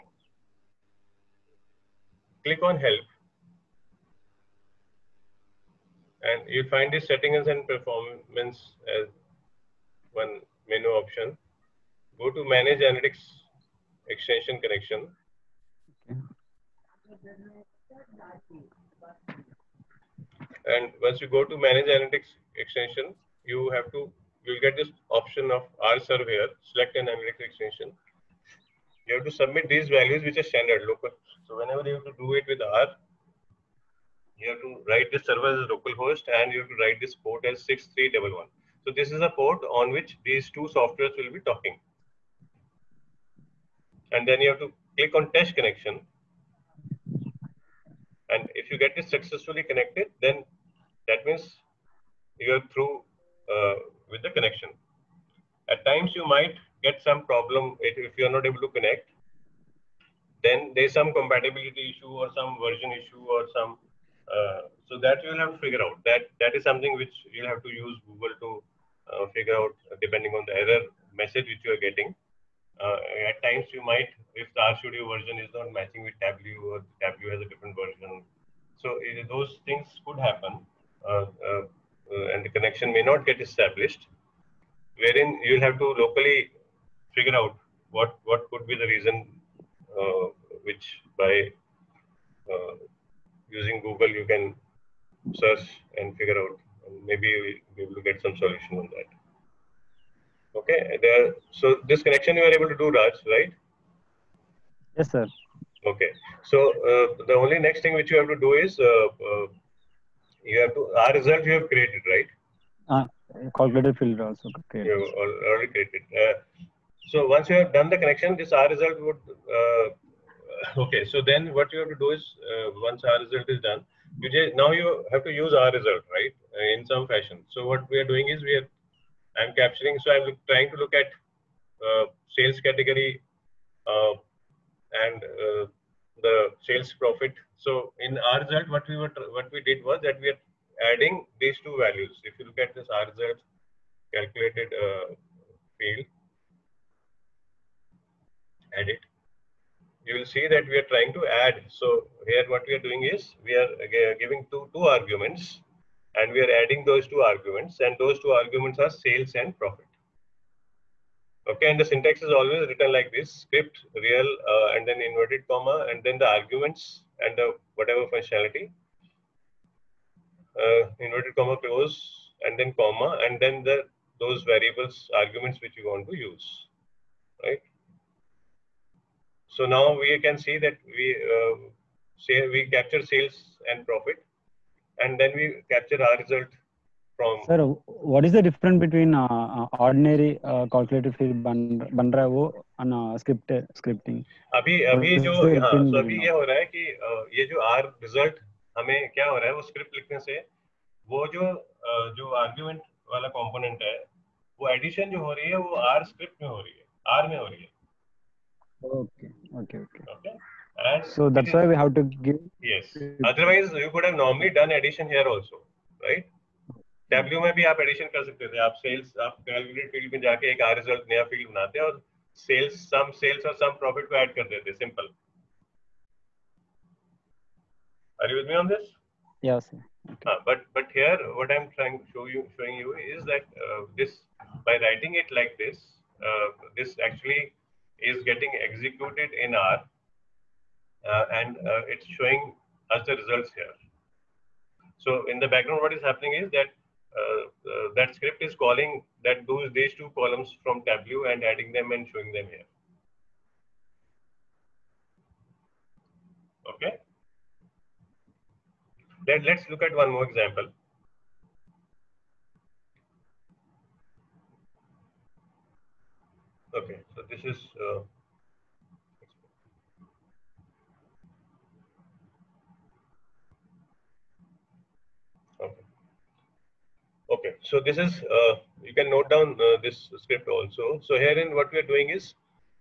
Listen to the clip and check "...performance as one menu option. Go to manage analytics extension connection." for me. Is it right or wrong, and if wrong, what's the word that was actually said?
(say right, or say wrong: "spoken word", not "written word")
right.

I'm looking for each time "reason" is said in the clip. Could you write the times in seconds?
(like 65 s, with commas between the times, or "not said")
88 s.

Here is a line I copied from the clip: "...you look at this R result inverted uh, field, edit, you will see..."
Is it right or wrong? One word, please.
wrong.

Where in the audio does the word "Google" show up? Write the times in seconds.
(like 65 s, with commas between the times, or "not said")
68 s, 93 s.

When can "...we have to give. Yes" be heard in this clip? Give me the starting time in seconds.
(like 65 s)
211 s.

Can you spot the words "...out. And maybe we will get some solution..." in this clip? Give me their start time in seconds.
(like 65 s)
96 s.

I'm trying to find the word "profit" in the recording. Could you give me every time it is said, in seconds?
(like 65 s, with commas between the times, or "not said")
136 s, 159 s, 183 s, 223 s.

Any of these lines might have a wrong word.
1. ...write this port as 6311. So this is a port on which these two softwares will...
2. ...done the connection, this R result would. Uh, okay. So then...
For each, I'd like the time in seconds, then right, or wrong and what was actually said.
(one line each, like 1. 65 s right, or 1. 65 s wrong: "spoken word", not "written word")
1. 36 s right
2. 117 s right.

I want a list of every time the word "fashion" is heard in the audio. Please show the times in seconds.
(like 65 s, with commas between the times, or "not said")
127 s.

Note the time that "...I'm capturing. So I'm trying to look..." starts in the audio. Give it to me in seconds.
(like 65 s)
129 s.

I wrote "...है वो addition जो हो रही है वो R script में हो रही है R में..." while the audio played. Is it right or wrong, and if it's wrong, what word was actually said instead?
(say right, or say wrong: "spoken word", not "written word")
right.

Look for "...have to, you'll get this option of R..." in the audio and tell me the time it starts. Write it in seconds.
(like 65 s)
23 s.